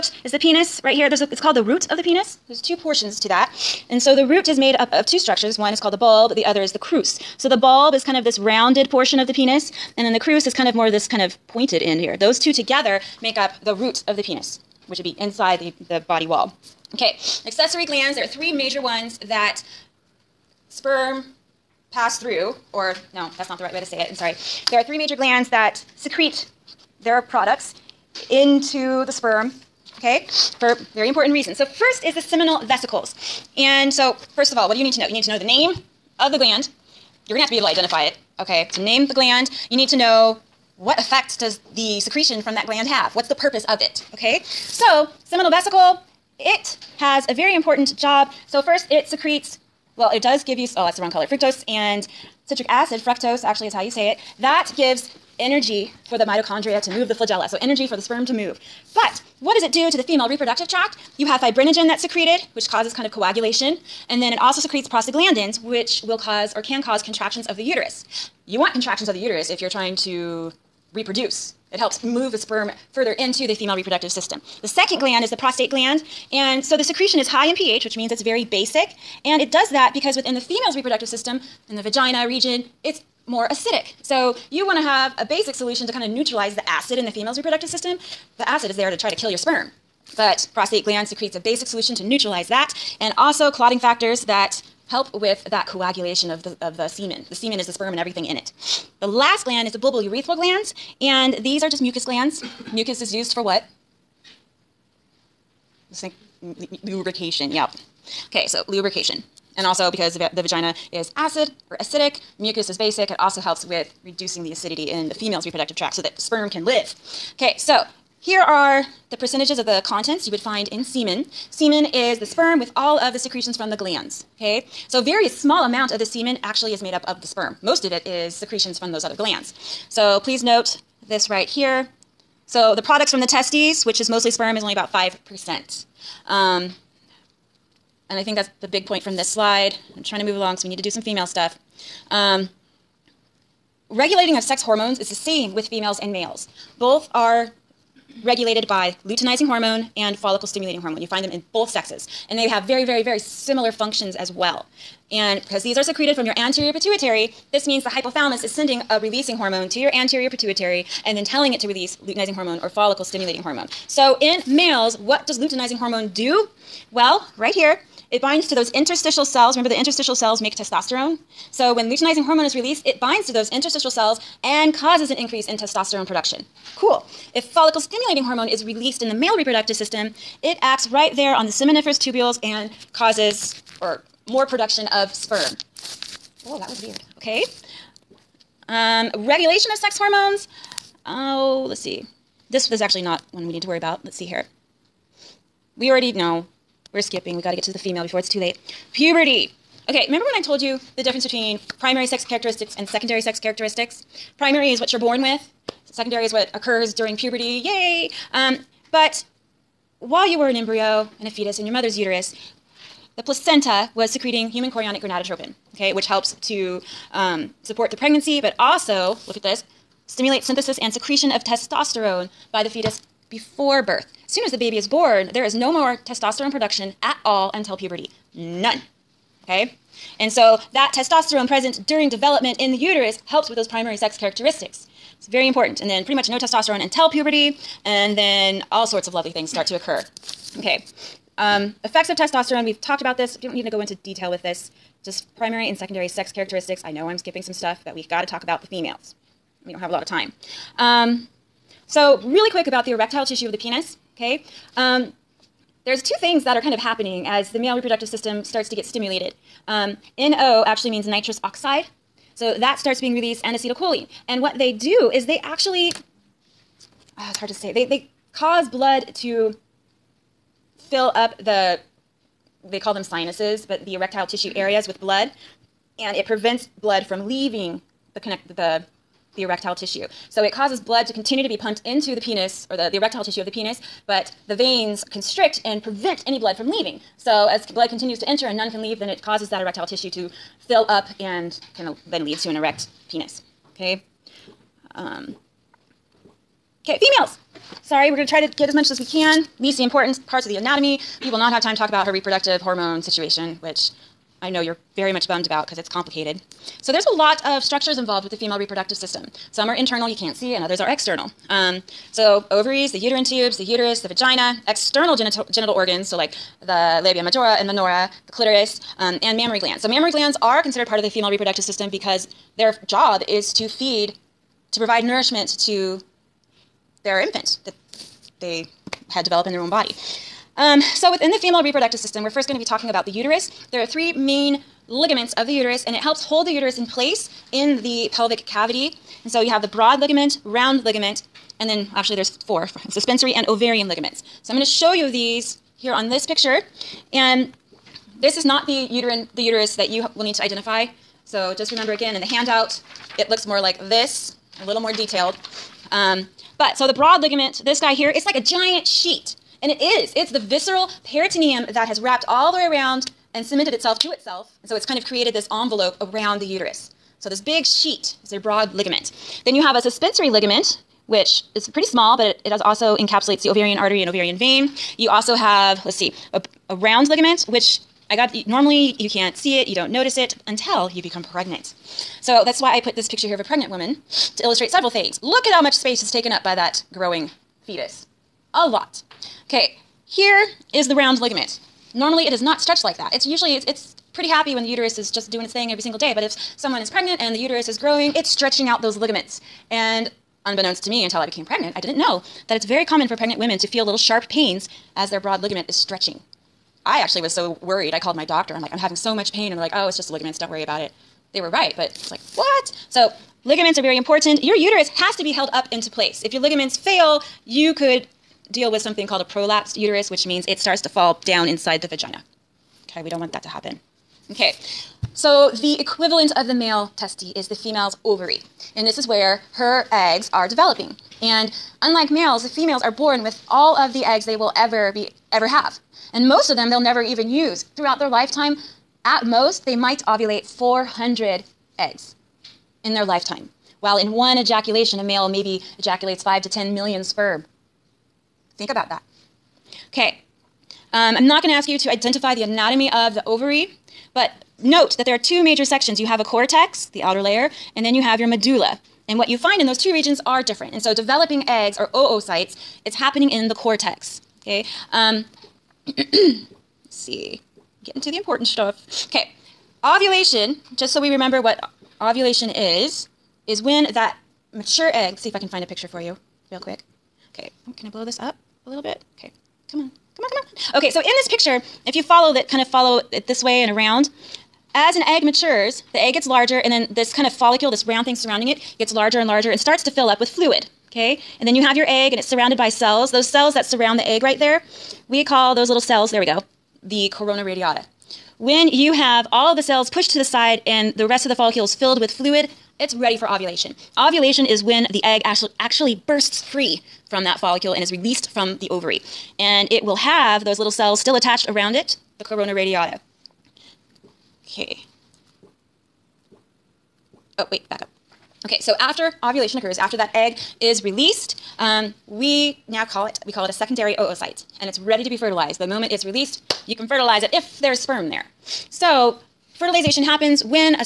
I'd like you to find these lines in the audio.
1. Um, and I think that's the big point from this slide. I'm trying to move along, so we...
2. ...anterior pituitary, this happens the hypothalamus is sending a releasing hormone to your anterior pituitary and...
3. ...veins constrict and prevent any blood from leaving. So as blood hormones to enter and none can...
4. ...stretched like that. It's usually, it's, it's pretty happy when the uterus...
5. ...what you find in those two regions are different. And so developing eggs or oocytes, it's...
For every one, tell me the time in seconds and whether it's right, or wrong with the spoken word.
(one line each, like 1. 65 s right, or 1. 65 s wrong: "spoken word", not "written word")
1. 136 s right
2. 156 s wrong: "means", not "happens"
3. 284 s wrong: "continues", not "hormones"
4. 392 s right
5. 459 s right.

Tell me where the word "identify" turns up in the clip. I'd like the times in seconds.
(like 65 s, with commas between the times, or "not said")
37 s, 350 s, 451 s.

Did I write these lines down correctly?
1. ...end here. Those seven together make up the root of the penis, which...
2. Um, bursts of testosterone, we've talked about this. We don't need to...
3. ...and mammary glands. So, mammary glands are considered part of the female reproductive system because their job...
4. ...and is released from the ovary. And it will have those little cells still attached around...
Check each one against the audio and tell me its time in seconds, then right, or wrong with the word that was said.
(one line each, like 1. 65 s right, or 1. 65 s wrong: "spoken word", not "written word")
1. 11 s wrong: "two", not "seven"
2. 241 s wrong: "effects", not "bursts"
3. 319 s right
4. 507 s right.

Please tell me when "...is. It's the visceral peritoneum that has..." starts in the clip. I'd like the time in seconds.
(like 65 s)
359 s.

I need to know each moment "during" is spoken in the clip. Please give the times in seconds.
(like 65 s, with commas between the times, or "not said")
206 s, 231 s.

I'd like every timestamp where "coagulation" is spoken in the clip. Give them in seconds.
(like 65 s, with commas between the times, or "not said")
63 s, 95 s.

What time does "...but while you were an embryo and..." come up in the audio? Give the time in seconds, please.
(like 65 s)
208 s.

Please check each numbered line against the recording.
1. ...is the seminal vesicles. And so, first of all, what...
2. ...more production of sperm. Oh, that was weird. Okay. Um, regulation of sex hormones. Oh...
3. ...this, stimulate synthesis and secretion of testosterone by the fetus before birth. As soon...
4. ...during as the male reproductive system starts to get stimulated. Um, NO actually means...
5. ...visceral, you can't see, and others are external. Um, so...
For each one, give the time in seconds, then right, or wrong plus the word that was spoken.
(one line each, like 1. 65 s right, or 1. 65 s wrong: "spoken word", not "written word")
1. 32 s right
2. 184 s right
3. 219 s right
4. 256 s wrong: "happening", not "during"
5. 309 s wrong: "internal", not "visceral".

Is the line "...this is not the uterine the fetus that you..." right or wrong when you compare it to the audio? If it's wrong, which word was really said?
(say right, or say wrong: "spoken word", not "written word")
wrong: "uterus", not "fetus".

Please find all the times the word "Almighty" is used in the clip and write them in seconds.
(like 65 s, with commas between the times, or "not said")
not said.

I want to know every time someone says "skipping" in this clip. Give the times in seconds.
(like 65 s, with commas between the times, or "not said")
197 s, 247 s.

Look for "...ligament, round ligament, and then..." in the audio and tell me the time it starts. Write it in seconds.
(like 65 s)
339 s.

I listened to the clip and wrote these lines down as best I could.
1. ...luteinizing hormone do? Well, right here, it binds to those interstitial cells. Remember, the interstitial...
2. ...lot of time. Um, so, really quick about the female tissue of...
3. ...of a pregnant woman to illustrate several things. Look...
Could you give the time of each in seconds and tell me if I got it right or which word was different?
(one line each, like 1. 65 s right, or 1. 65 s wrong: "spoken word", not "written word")
1. 165 s right
2. 249 s wrong: "erectile", not "female"
3. 383 s right.